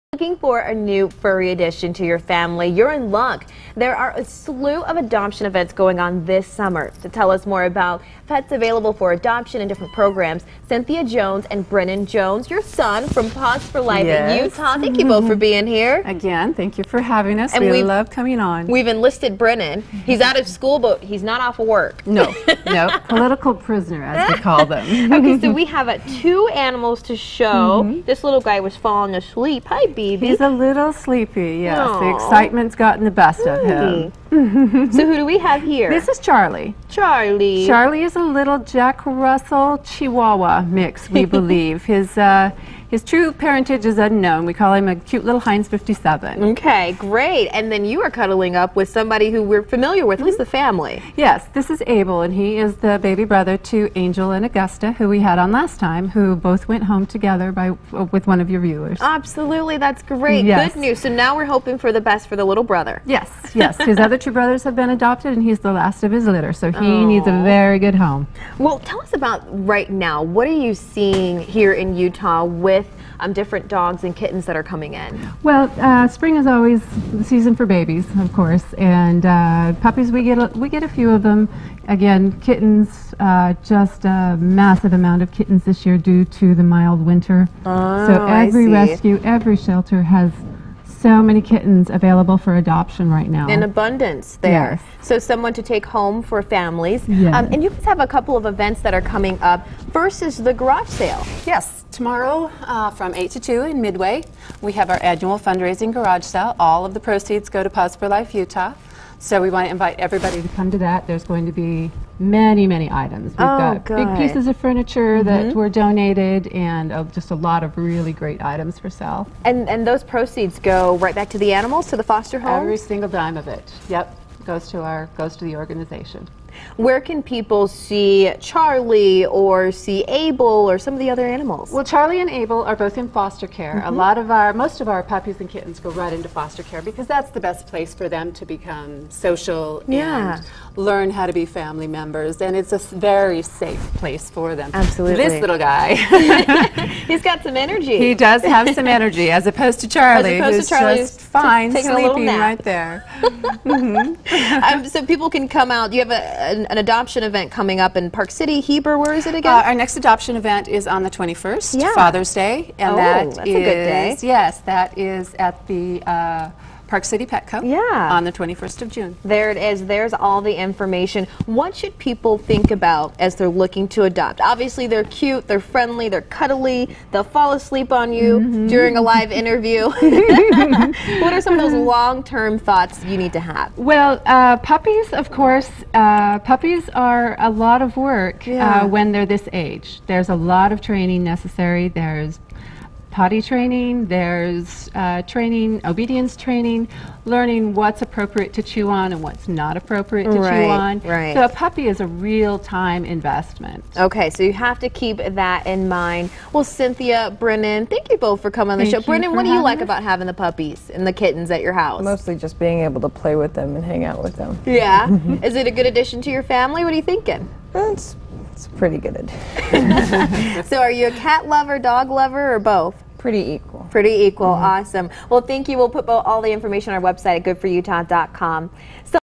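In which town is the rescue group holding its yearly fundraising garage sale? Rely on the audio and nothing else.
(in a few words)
Midway.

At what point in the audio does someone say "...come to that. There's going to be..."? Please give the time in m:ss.
1:50.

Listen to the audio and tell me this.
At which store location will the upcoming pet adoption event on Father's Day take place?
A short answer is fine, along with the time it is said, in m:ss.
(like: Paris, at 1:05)
Park City Petco, at 2:46.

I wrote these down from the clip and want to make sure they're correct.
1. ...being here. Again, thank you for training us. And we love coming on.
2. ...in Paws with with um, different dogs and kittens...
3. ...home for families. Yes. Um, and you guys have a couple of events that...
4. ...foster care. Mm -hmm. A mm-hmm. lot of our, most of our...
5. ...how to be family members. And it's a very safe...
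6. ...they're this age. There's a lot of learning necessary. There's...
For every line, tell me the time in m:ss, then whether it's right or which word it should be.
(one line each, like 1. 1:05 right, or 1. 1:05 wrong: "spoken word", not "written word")
1. 0:15 wrong: "having", not "training"
2. 1:11 wrong: "Utah", not "Paws"
3. 1:35 right
4. 2:13 right
5. 2:21 right
6. 3:09 wrong: "training", not "learning".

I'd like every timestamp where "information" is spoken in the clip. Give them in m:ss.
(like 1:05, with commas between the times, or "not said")
2:50, 3:46.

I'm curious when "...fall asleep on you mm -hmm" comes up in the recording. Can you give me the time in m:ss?
2:57.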